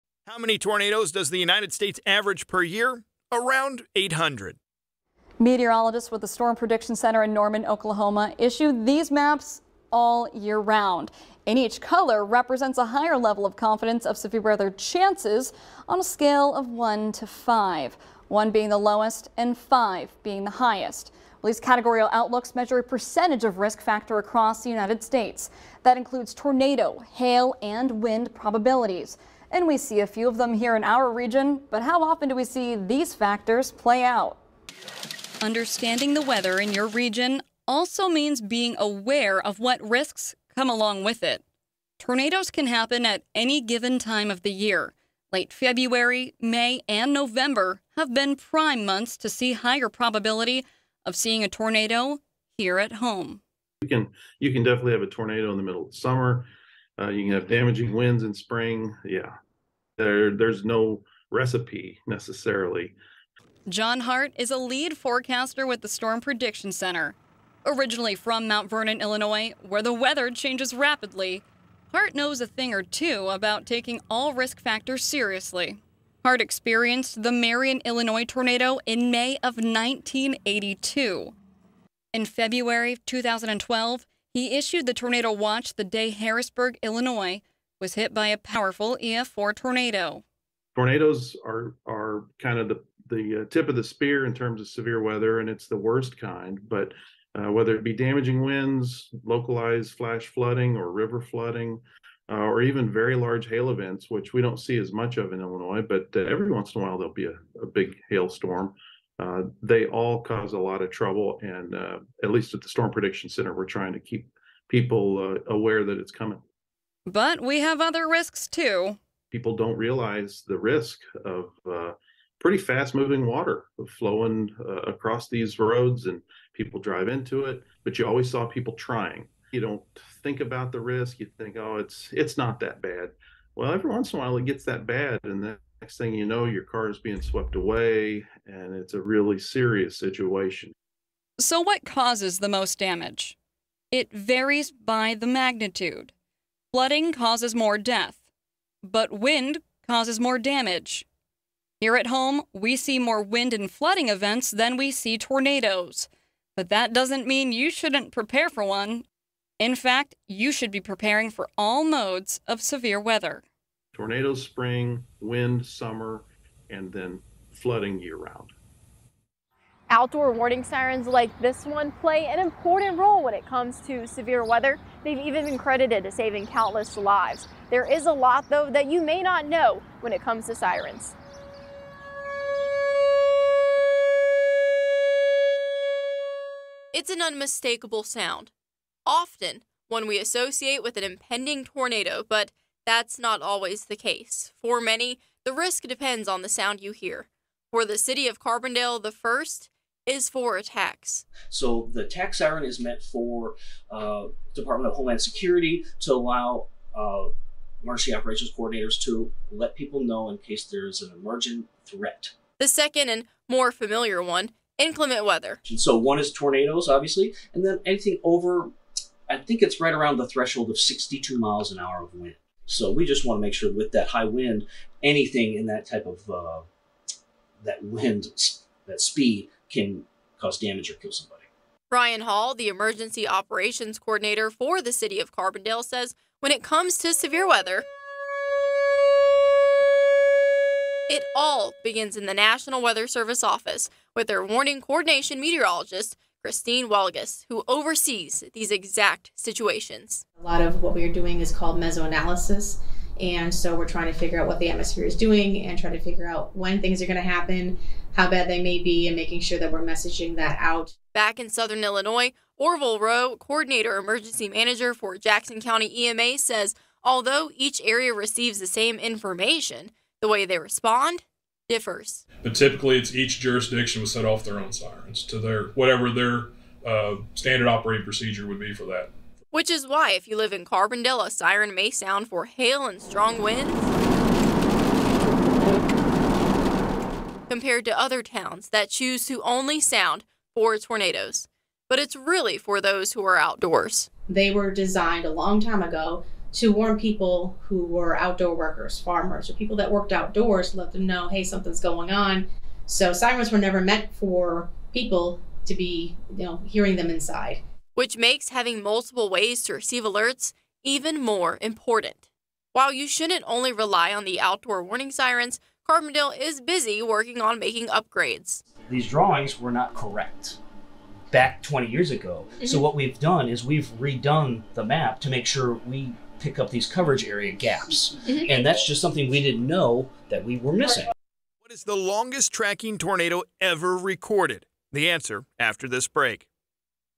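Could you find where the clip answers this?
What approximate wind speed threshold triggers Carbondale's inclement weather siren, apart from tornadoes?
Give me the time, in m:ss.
3:40.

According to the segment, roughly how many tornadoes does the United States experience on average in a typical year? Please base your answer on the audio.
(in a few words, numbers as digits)
800.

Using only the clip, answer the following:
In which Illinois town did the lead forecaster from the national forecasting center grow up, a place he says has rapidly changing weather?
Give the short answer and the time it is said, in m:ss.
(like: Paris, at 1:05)
Mount Vernon, Illinois, at 1:08.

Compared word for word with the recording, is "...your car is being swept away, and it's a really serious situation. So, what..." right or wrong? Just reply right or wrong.
right.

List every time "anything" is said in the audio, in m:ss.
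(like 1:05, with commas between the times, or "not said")
3:37, 3:45.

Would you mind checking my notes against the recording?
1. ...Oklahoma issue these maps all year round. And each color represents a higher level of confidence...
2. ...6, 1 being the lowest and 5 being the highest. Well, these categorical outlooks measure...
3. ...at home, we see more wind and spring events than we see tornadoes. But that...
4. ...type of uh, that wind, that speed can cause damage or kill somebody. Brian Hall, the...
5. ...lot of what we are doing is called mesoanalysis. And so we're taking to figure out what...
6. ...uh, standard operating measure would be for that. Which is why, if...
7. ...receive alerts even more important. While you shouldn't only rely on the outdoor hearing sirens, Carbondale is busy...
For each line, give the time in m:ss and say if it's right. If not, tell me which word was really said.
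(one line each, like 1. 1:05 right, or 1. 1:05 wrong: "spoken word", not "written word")
1. 0:07 right
2. 0:17 wrong: "5", not "6"
3. 2:31 wrong: "flooding", not "spring"
4. 3:45 right
5. 4:10 wrong: "trying", not "taking"
6. 4:36 wrong: "procedure", not "measure"
7. 5:09 wrong: "warning", not "hearing".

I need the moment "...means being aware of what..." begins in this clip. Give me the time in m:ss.
0:38.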